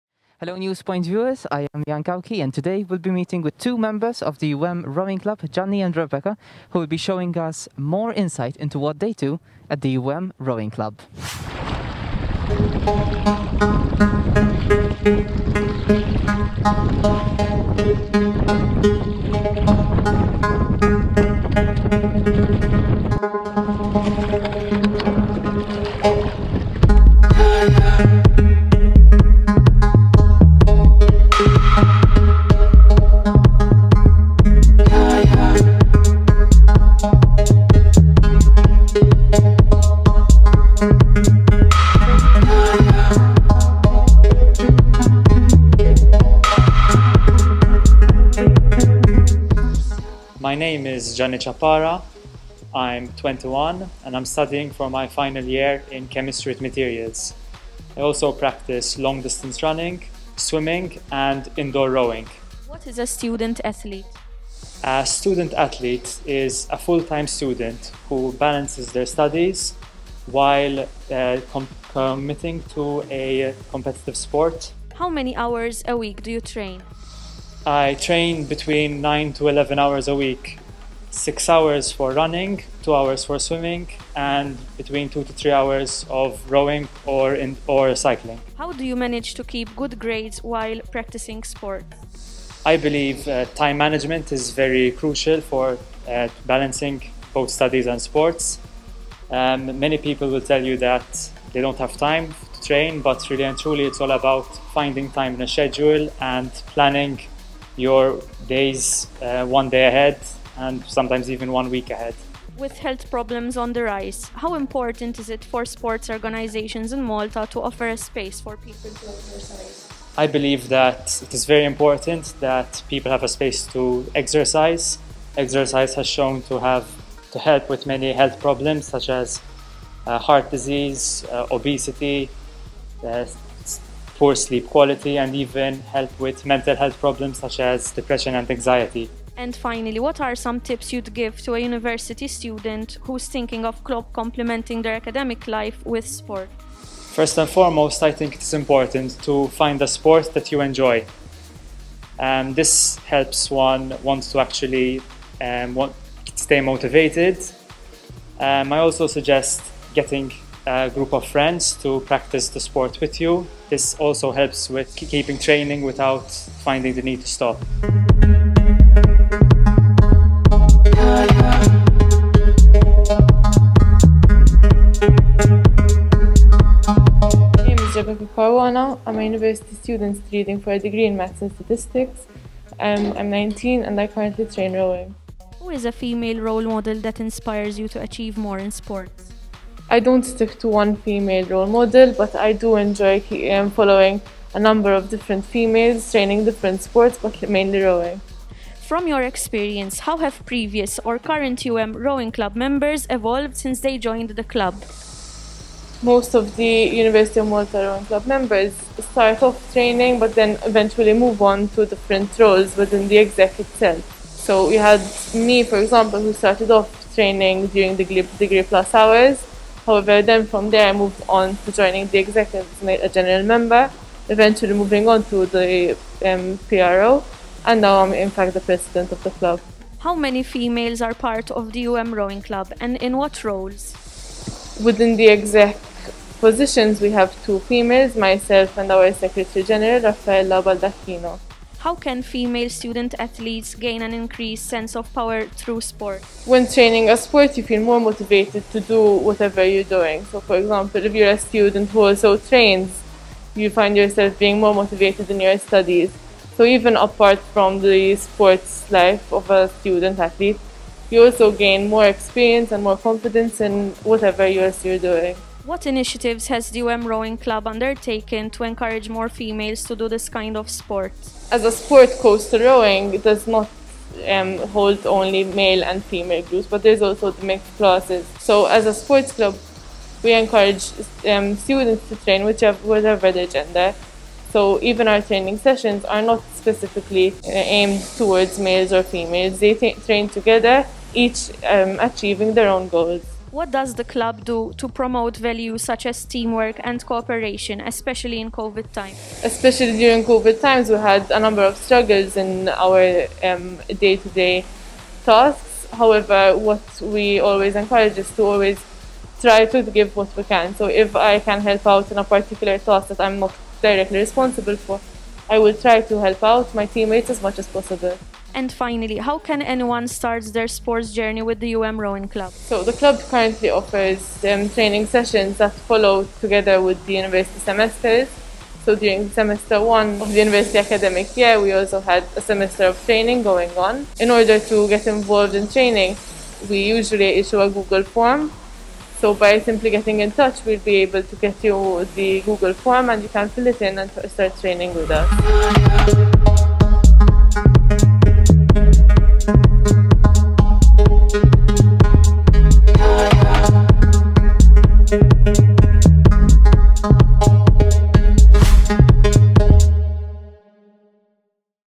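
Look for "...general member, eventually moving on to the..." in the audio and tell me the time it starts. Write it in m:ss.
3:43.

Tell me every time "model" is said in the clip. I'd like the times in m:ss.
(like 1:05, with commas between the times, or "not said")
3:06, 3:11.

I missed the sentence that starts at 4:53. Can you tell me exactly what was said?
What does the club do to promote values such as teamwork and cooperation, especially in COVID times?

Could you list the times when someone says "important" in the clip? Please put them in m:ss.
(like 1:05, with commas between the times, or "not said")
1:54, 2:01, 2:28.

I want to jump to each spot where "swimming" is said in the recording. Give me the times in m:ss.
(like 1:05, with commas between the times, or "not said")
1:00, 1:23.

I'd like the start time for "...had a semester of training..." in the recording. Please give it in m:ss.
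5:32.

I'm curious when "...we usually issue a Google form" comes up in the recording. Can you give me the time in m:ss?
5:36.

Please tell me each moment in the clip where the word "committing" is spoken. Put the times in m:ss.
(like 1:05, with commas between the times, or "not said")
1:11.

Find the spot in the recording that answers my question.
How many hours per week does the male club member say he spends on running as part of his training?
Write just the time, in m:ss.
1:21.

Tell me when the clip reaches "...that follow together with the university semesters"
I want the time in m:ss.
5:25.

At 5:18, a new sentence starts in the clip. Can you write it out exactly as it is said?
And finally, how can anyone start their sports journey with the UM Rowing Club?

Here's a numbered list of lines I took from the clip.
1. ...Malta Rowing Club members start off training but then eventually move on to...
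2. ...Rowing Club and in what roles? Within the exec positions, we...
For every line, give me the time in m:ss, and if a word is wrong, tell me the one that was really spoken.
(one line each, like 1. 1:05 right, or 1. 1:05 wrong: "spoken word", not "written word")
1. 3:27 right
2. 3:52 right.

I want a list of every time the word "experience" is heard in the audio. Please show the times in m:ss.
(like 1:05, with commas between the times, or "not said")
3:19, 4:22.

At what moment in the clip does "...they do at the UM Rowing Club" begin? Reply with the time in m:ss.
0:08.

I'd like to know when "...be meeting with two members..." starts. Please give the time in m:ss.
0:02.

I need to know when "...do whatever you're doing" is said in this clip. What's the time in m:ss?
4:08.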